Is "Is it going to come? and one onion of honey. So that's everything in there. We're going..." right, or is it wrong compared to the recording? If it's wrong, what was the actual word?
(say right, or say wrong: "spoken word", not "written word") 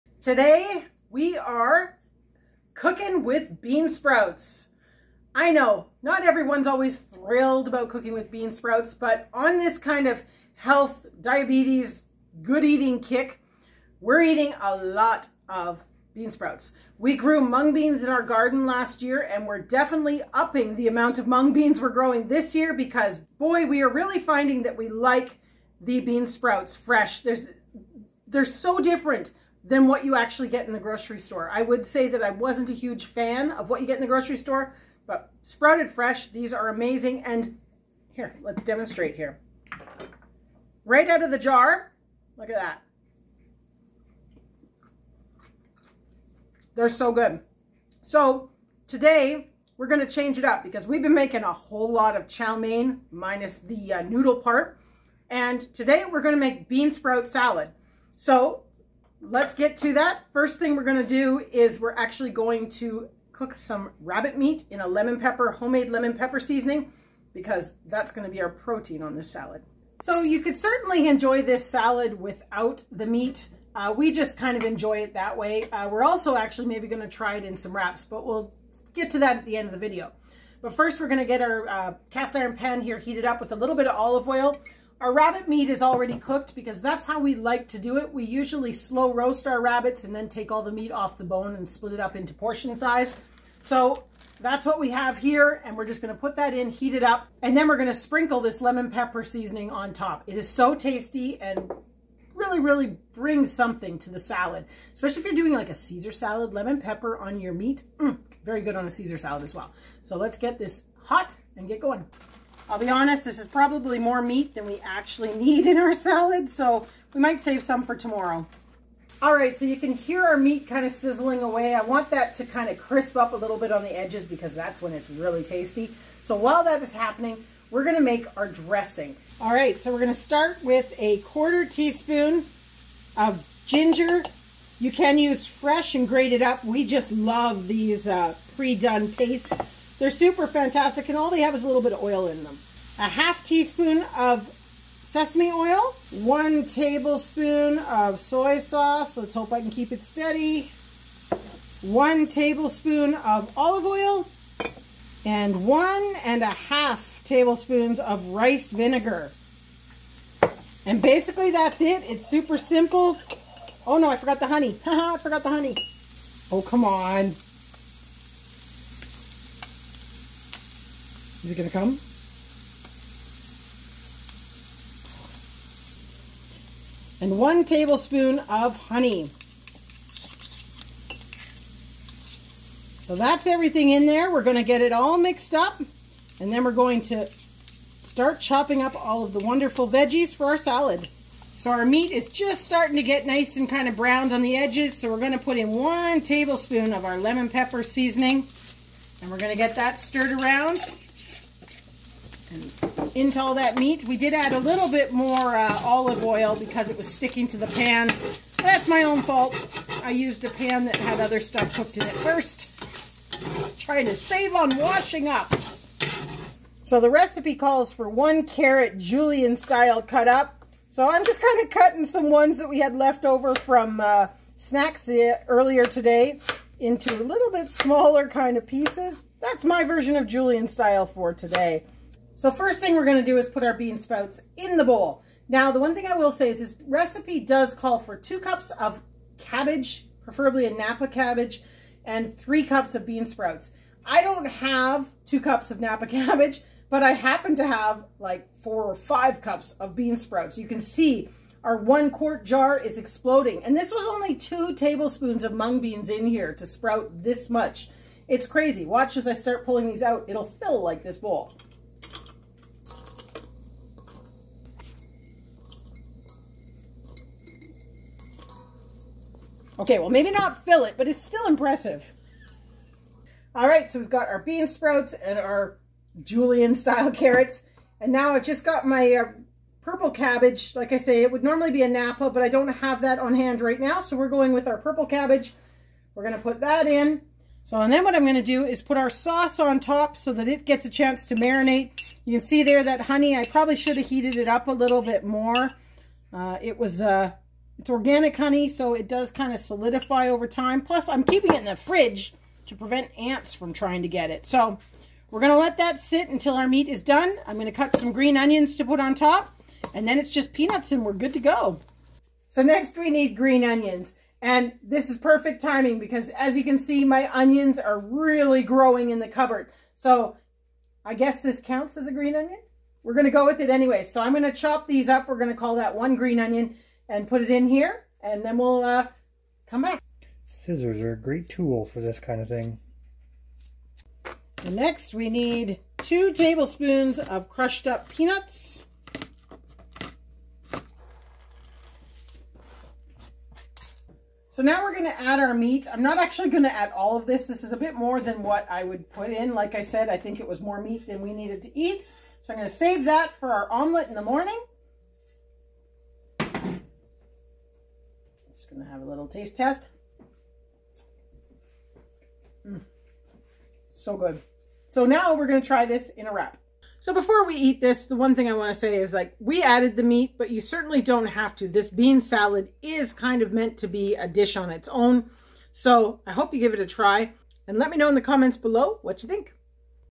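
wrong: "tablespoon", not "onion".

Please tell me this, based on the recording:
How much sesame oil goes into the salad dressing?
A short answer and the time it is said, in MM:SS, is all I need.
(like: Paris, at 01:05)
1/2 teaspoon, at 02:22.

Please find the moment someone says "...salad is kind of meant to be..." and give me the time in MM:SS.
06:12.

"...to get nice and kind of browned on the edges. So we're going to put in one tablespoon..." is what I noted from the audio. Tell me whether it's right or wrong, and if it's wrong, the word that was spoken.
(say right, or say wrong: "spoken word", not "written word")
right.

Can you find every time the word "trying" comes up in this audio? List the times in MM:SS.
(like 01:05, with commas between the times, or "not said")
03:33, 05:03.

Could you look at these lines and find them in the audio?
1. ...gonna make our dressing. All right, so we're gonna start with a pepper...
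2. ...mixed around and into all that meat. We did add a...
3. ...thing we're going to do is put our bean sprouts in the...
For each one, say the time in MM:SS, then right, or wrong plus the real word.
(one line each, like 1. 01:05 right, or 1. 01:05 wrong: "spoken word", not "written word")
1. 02:07 wrong: "quarter", not "pepper"
2. 03:19 wrong: "stirred", not "mixed"
3. 03:52 right.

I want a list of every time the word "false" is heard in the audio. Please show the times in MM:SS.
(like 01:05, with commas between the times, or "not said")
not said.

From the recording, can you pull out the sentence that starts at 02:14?
You can use fresh and grated up.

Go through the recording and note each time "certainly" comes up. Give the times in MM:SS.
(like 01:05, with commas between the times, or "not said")
01:10, 06:10.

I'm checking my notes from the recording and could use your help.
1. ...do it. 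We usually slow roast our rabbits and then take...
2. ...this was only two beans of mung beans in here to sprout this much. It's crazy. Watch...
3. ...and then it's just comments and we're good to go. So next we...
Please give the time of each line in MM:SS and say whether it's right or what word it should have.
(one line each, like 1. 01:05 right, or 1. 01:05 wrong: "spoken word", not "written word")
1. 01:27 right
2. 04:13 wrong: "tablespoons", not "beans"
3. 05:09 wrong: "peanuts", not "comments".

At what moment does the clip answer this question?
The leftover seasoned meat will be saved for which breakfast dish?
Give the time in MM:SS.
05:53.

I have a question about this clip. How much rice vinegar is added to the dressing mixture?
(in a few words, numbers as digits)
1.5 tablespoons.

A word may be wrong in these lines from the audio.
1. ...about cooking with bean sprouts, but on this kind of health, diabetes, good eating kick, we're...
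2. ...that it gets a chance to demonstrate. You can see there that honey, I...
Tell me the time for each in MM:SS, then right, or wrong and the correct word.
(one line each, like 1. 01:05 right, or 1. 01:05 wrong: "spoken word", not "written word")
1. 00:07 right
2. 04:50 wrong: "marinate", not "demonstrate".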